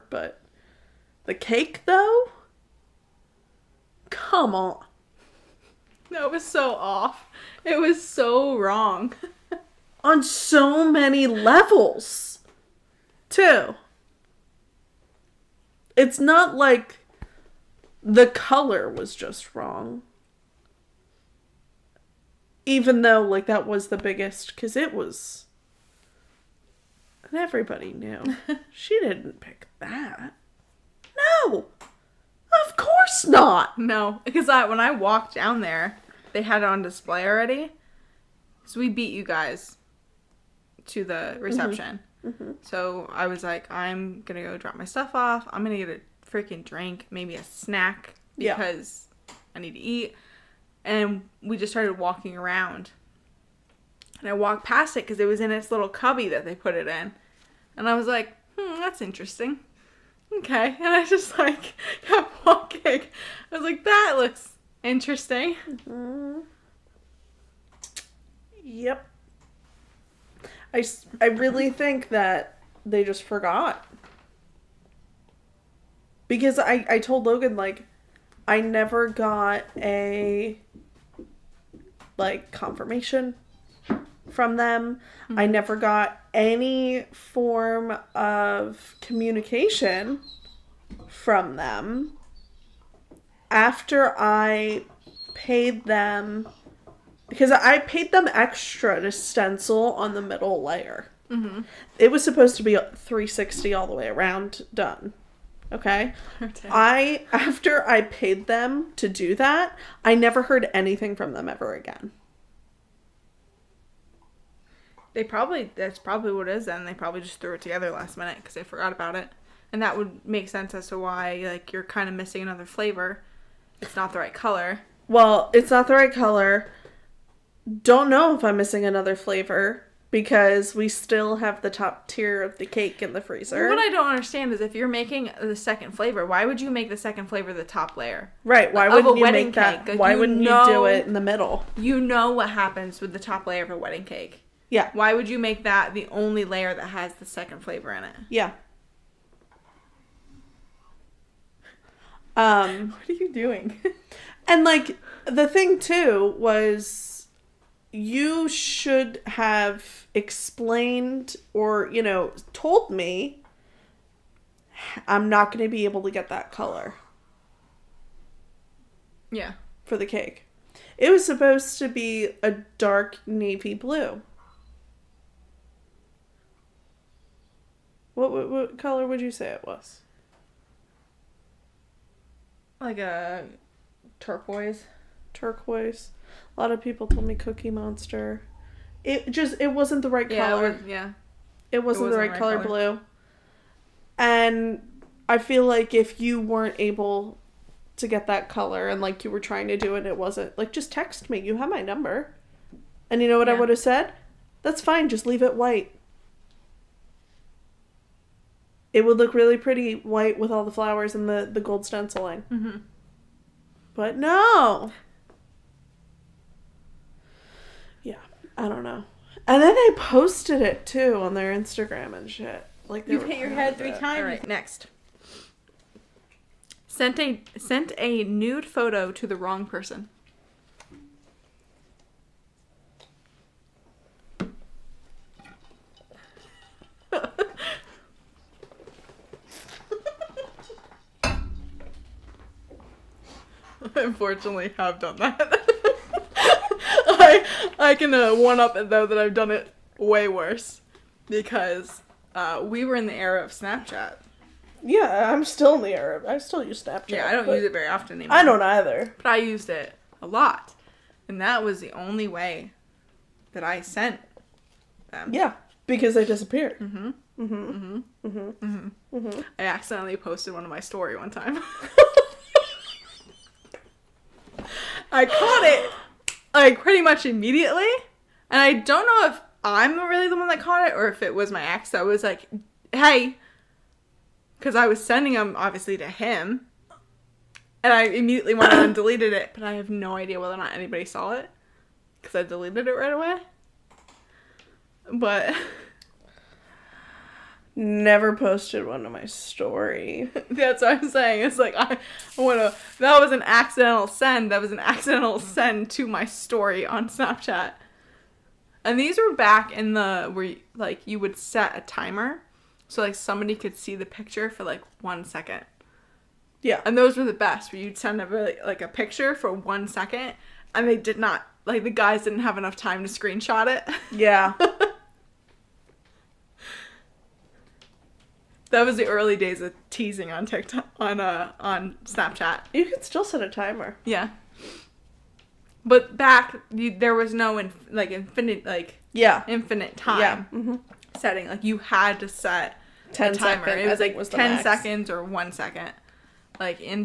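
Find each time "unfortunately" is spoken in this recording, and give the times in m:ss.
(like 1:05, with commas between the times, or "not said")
4:04.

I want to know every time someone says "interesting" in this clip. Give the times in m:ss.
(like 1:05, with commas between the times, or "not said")
0:59, 1:04.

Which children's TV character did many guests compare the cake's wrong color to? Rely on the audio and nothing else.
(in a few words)
Cookie Monster.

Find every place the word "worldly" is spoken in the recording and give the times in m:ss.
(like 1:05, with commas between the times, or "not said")
not said.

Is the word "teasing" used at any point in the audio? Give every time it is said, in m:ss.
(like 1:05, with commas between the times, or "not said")
5:29.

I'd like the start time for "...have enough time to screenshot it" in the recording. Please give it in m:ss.
5:22.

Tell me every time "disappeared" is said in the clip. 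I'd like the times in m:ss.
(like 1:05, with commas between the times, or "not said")
4:26.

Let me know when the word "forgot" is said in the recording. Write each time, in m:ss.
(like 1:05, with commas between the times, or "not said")
1:13, 1:58.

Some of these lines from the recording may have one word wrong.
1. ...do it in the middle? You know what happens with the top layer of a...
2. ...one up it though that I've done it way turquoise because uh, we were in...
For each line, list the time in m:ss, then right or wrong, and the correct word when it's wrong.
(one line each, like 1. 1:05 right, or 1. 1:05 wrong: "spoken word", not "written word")
1. 2:20 right
2. 4:08 wrong: "worse", not "turquoise".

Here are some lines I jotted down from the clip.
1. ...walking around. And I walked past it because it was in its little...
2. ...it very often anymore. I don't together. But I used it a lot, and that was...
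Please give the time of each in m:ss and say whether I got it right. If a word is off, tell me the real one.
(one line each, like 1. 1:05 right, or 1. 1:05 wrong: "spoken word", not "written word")
1. 0:51 right
2. 4:17 wrong: "either", not "together".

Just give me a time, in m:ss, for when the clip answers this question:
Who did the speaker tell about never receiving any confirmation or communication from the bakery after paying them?
1:17.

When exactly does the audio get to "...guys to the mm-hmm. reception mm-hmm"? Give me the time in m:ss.
0:39.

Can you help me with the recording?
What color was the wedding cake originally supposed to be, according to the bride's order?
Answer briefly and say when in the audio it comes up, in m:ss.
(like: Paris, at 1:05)
dark navy blue, at 2:52.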